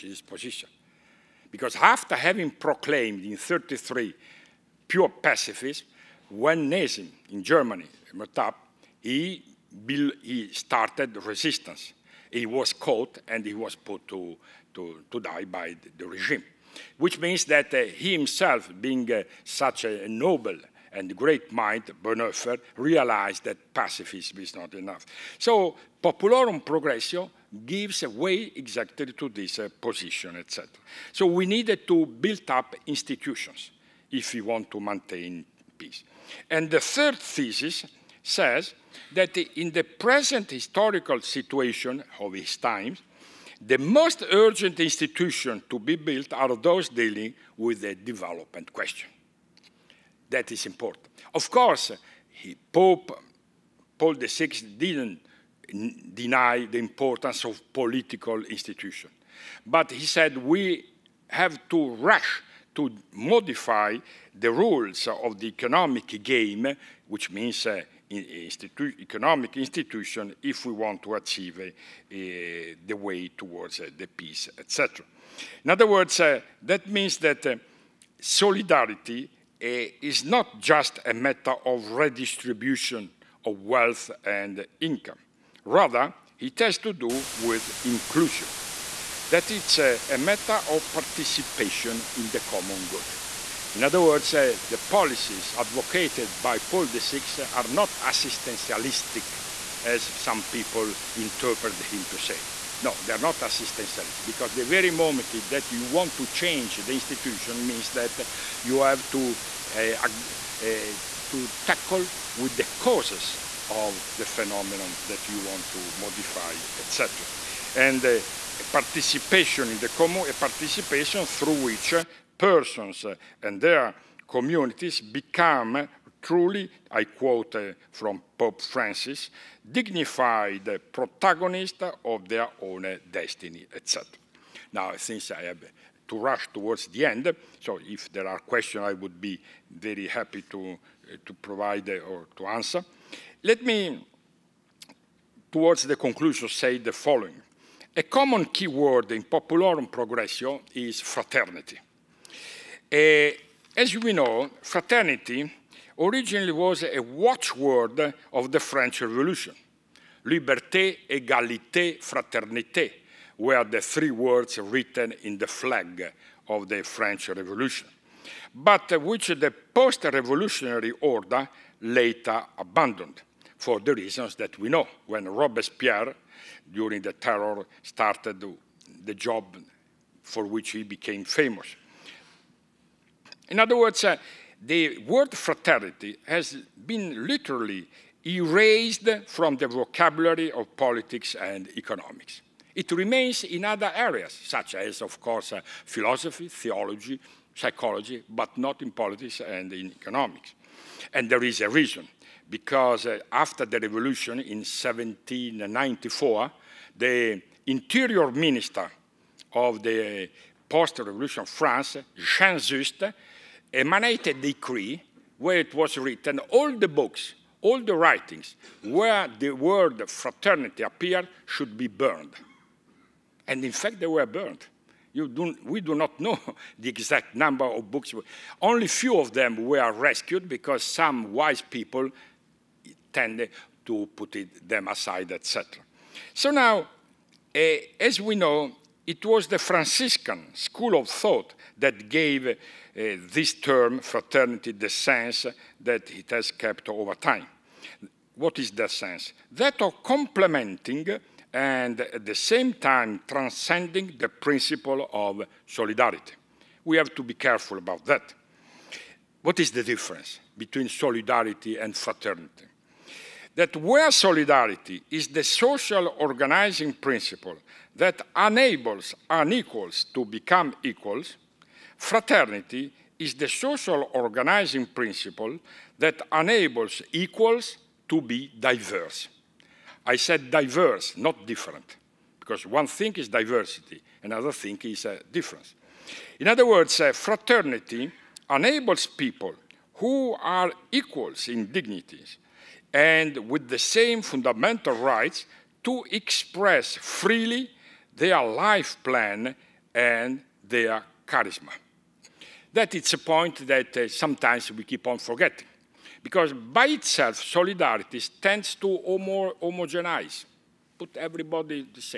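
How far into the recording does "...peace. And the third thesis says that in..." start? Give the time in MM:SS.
00:35.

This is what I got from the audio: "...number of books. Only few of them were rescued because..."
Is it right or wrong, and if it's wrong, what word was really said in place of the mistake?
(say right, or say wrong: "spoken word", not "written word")
right.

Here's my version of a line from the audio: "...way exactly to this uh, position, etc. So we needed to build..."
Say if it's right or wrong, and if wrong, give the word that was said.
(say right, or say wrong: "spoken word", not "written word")
right.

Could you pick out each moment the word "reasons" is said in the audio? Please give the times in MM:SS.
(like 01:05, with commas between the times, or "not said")
02:53, 03:21.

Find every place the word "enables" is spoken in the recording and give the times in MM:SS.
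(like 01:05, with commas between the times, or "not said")
04:28, 04:36, 04:48.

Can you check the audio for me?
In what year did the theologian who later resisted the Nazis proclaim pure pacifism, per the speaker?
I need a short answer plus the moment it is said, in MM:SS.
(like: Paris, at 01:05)
1933, at 00:03.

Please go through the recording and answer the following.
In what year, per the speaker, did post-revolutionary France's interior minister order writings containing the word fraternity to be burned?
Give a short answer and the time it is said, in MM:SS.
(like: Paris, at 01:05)
1794, at 03:24.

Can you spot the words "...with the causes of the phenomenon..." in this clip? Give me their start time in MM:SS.
01:52.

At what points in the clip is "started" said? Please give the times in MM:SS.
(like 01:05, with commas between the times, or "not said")
00:10, 02:57.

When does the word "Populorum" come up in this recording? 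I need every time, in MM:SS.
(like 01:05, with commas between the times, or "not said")
00:26, 02:29.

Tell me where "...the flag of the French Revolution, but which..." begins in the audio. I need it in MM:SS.
02:45.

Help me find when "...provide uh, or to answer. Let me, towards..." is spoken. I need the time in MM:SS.
02:21.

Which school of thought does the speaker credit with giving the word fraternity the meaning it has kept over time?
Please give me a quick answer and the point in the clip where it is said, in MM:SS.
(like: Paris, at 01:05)
Franciscan school, at 03:59.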